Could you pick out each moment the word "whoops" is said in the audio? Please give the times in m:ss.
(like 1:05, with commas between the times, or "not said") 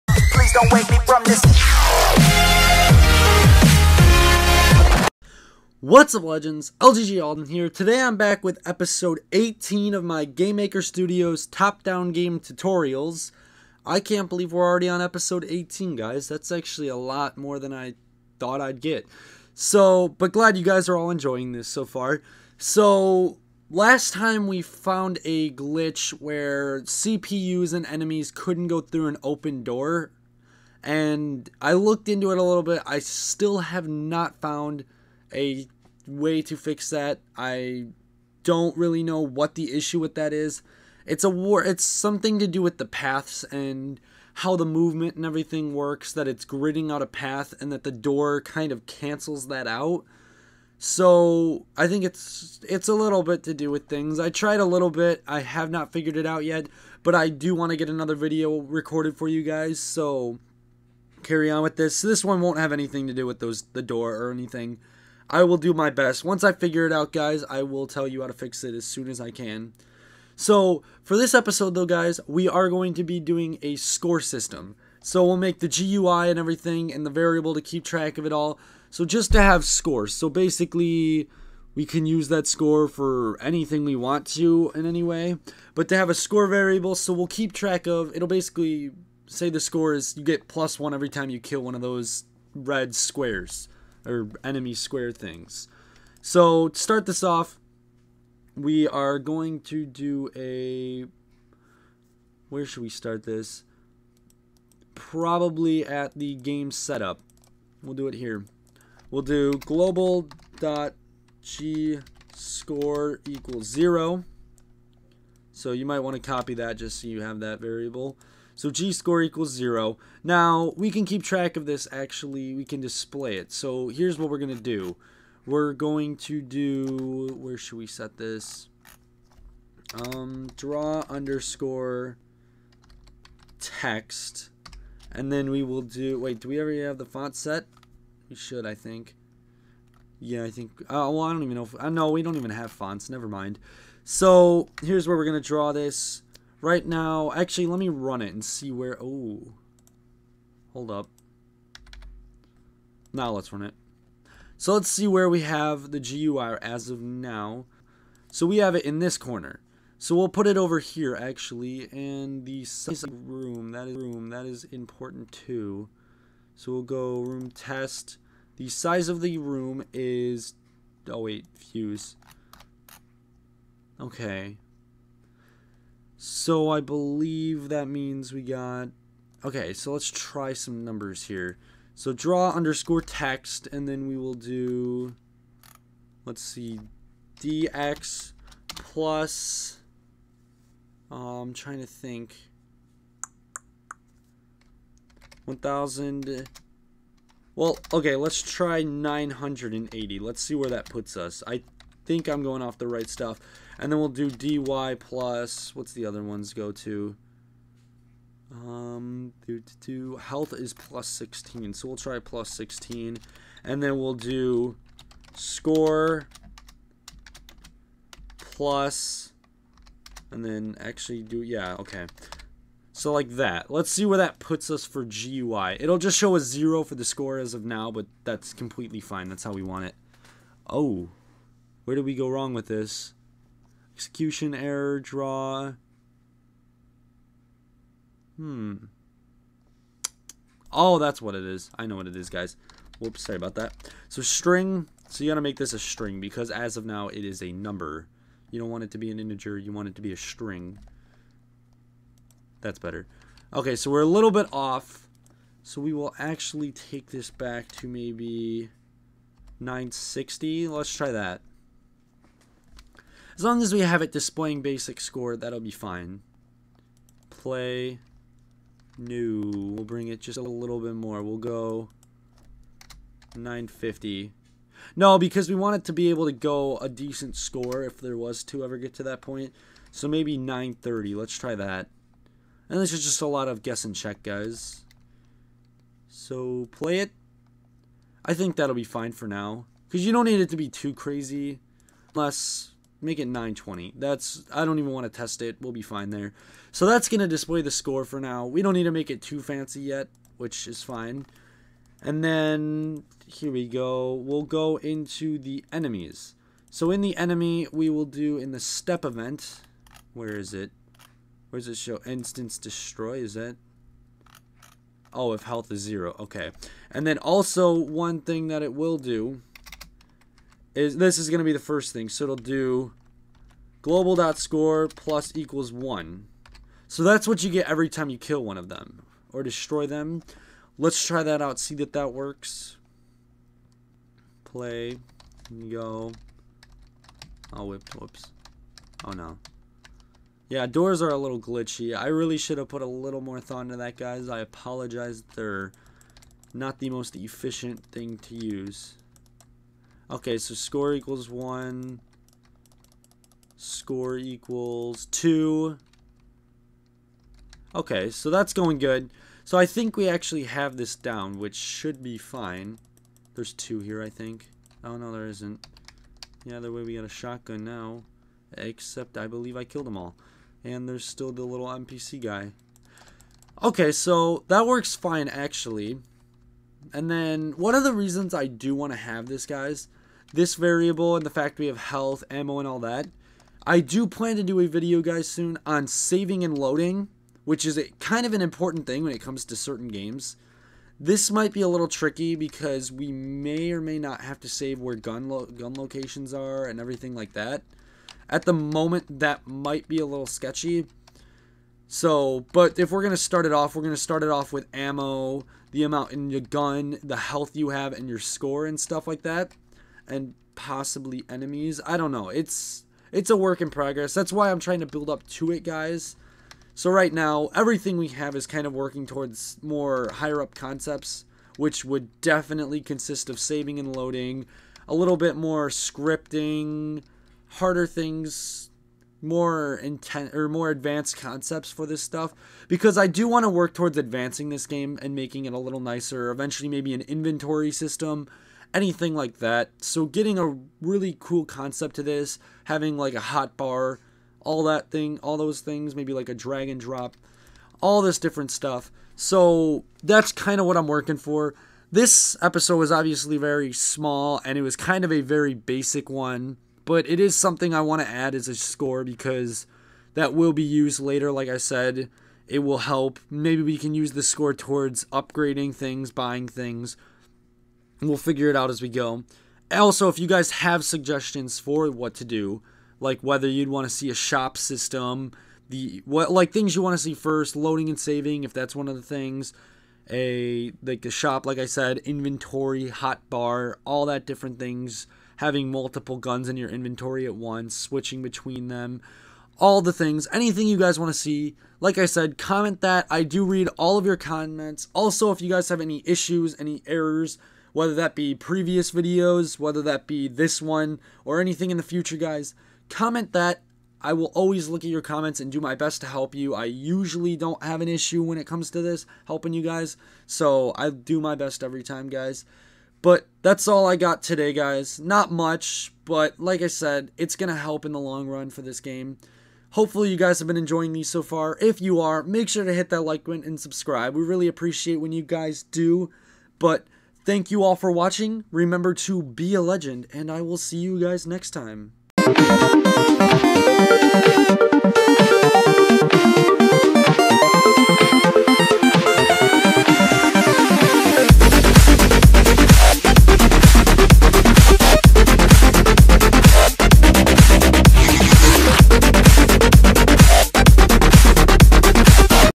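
4:02, 5:37.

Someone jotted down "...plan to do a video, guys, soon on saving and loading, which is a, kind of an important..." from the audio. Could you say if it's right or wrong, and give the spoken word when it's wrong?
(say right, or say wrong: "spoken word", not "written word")
right.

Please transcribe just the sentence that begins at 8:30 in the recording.
So I do my best every time, guys.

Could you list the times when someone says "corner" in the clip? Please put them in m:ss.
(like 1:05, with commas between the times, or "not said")
2:39.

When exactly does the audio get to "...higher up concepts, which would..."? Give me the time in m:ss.
7:00.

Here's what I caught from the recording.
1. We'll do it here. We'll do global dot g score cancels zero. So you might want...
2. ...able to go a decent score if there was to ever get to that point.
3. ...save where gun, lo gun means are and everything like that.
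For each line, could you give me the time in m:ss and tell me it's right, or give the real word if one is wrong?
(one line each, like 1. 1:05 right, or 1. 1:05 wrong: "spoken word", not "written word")
1. 1:47 wrong: "equals", not "cancels"
2. 4:36 right
3. 6:34 wrong: "locations", not "means".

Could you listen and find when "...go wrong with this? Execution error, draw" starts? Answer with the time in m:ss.
3:52.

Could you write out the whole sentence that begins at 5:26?
So that's what you get every time you kill one of them or destroy them.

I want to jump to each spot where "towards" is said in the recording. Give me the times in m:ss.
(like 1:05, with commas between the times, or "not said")
6:59, 7:13, 7:44.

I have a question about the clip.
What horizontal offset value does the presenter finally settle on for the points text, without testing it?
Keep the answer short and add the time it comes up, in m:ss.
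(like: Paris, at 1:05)
920, at 4:53.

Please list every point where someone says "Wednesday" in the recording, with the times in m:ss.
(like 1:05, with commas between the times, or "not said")
not said.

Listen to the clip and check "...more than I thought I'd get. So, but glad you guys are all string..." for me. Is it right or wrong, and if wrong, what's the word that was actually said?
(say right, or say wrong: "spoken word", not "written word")
wrong: "enjoying", not "string".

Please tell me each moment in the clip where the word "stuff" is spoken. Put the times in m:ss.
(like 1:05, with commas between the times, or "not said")
3:23, 6:48, 7:12, 7:28.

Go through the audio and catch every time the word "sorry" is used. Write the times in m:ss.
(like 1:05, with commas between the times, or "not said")
4:03.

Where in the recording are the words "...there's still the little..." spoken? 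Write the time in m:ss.
6:10.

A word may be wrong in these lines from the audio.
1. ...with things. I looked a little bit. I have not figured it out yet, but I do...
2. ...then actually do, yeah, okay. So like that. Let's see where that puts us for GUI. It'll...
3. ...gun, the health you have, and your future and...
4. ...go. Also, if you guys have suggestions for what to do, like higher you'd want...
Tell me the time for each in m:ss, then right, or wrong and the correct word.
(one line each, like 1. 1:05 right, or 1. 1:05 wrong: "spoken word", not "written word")
1. 0:53 wrong: "tried", not "looked"
2. 3:40 right
3. 6:46 wrong: "score", not "future"
4. 7:48 wrong: "whether", not "higher".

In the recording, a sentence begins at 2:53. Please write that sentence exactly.
Okay, so I believe that means we got...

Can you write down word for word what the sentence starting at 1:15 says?
So, we'll make the GUI and everything and the variable to keep track of it all.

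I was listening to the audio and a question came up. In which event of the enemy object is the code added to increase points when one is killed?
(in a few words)
step event.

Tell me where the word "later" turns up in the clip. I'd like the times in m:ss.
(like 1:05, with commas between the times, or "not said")
7:41.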